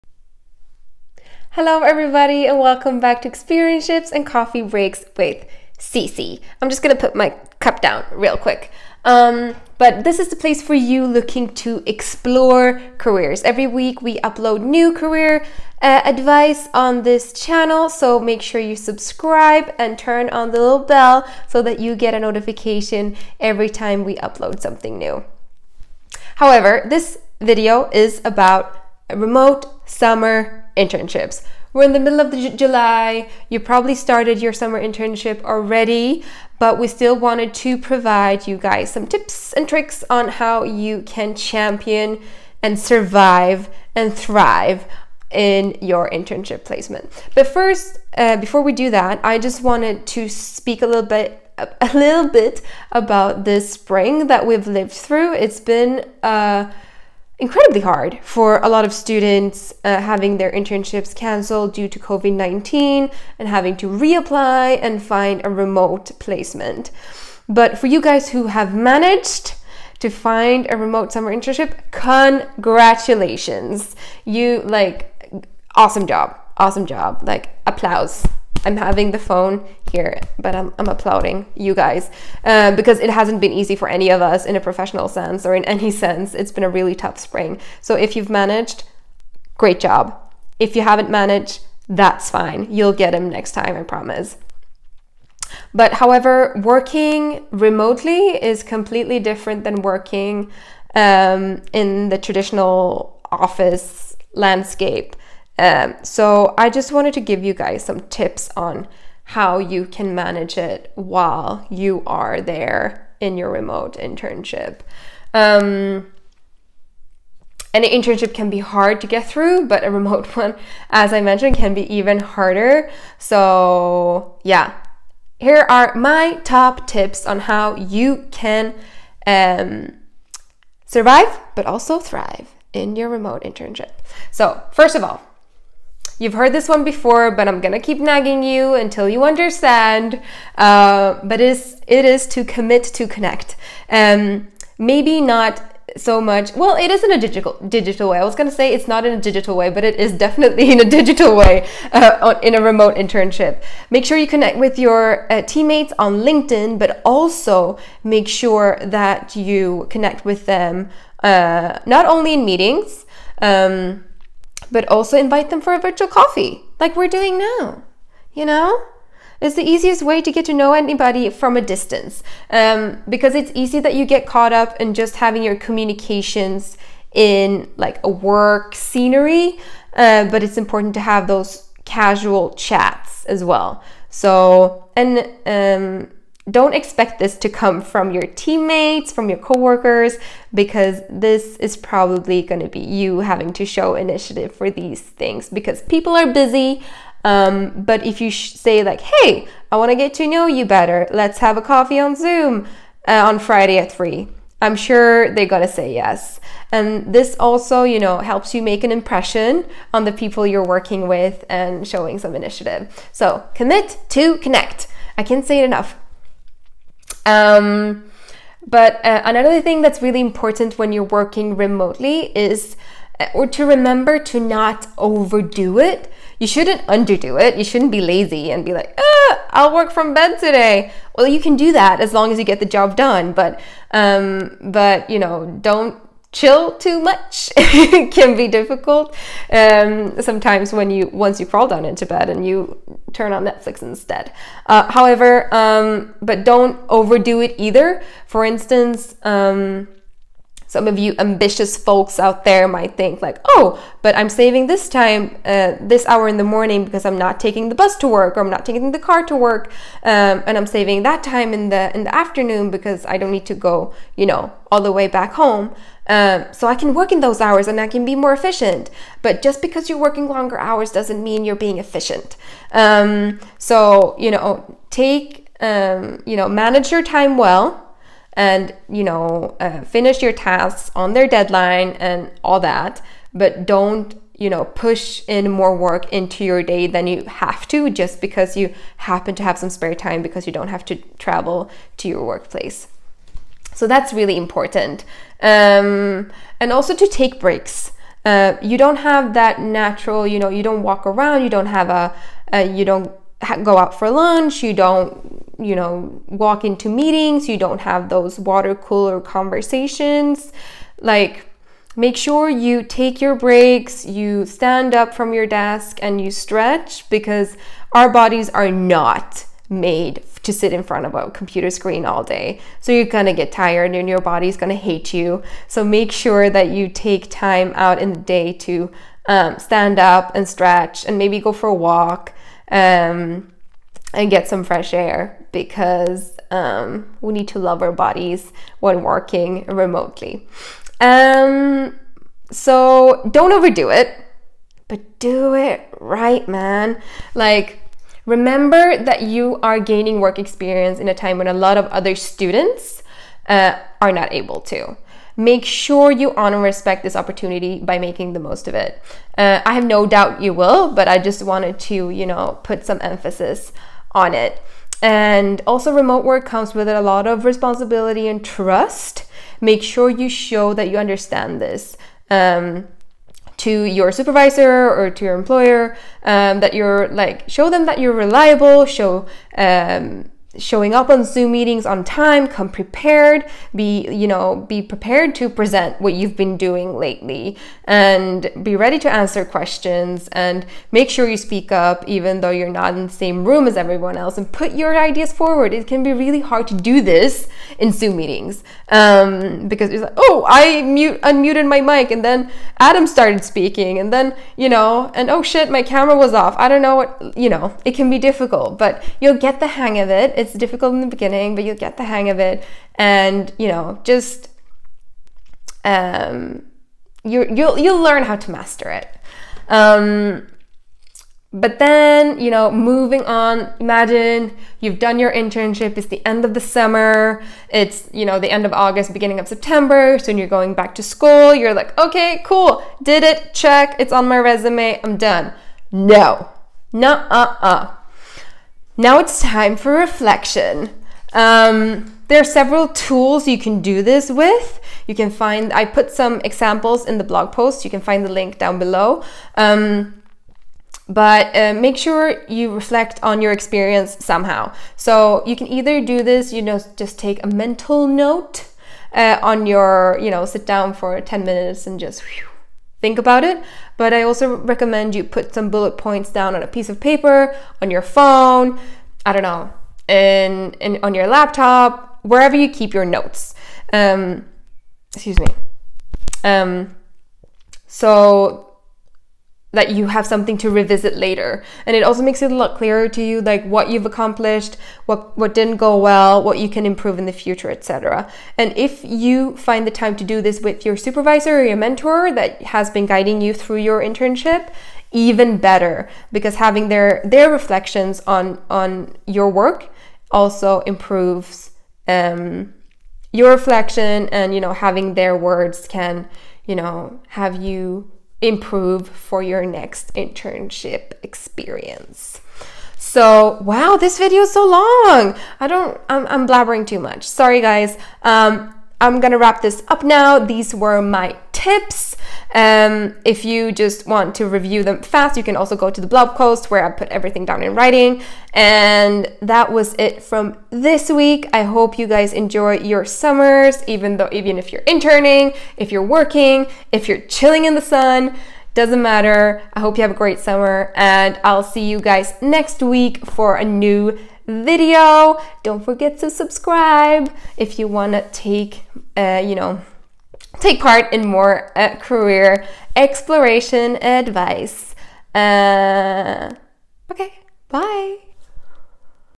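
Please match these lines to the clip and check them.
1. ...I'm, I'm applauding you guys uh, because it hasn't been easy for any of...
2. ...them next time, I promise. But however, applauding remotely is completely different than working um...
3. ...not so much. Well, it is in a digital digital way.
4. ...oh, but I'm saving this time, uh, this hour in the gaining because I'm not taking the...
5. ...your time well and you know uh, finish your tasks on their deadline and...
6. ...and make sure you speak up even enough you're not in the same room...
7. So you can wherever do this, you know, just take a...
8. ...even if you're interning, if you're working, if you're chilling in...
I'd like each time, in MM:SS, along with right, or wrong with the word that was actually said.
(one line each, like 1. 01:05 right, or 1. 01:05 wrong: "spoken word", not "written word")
1. 01:20 right
2. 01:33 wrong: "working", not "applauding"
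3. 02:25 right
4. 04:13 wrong: "morning", not "gaining"
5. 04:36 right
6. 06:30 wrong: "though", not "enough"
7. 07:34 wrong: "either", not "wherever"
8. 08:54 right.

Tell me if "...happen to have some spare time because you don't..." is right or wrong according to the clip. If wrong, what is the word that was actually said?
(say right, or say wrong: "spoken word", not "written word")
right.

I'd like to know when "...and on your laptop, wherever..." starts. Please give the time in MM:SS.
07:50.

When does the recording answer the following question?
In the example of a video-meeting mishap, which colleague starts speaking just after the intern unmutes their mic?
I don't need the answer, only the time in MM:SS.
06:42.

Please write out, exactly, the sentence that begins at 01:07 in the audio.
But for you guys who have managed, to find a remote summer internship, congratulations.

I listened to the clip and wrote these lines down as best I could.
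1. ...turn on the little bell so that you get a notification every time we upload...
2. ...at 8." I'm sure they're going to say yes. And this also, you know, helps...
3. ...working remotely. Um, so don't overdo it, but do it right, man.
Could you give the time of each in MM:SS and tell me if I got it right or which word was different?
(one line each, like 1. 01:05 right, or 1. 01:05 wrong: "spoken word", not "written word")
1. 00:19 right
2. 03:23 wrong: "3", not "8"
3. 05:39 right.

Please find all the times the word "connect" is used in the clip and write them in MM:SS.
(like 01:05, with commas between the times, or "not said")
02:23, 02:34, 02:39, 03:34.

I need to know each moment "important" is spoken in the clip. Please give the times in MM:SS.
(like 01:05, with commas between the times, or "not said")
03:00, 03:40, 04:54.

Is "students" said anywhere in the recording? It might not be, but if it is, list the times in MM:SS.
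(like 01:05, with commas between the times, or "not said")
00:58, 05:52.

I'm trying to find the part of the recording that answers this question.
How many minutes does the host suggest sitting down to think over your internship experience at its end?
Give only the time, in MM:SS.
07:41.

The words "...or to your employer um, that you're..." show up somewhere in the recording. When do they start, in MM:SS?
06:14.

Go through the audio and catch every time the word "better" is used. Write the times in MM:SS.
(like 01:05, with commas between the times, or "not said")
03:20, 08:15.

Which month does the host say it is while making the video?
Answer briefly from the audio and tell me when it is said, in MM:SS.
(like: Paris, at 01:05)
July, at 00:32.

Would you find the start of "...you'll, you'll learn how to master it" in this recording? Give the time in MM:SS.
06:57.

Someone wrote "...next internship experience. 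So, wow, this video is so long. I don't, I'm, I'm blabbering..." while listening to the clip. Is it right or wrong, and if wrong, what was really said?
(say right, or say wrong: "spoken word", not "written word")
right.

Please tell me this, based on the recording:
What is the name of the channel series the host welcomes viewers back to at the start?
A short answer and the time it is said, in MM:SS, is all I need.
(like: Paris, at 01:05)
Xperienceships and Coffee Breaks with Cece, at 00:03.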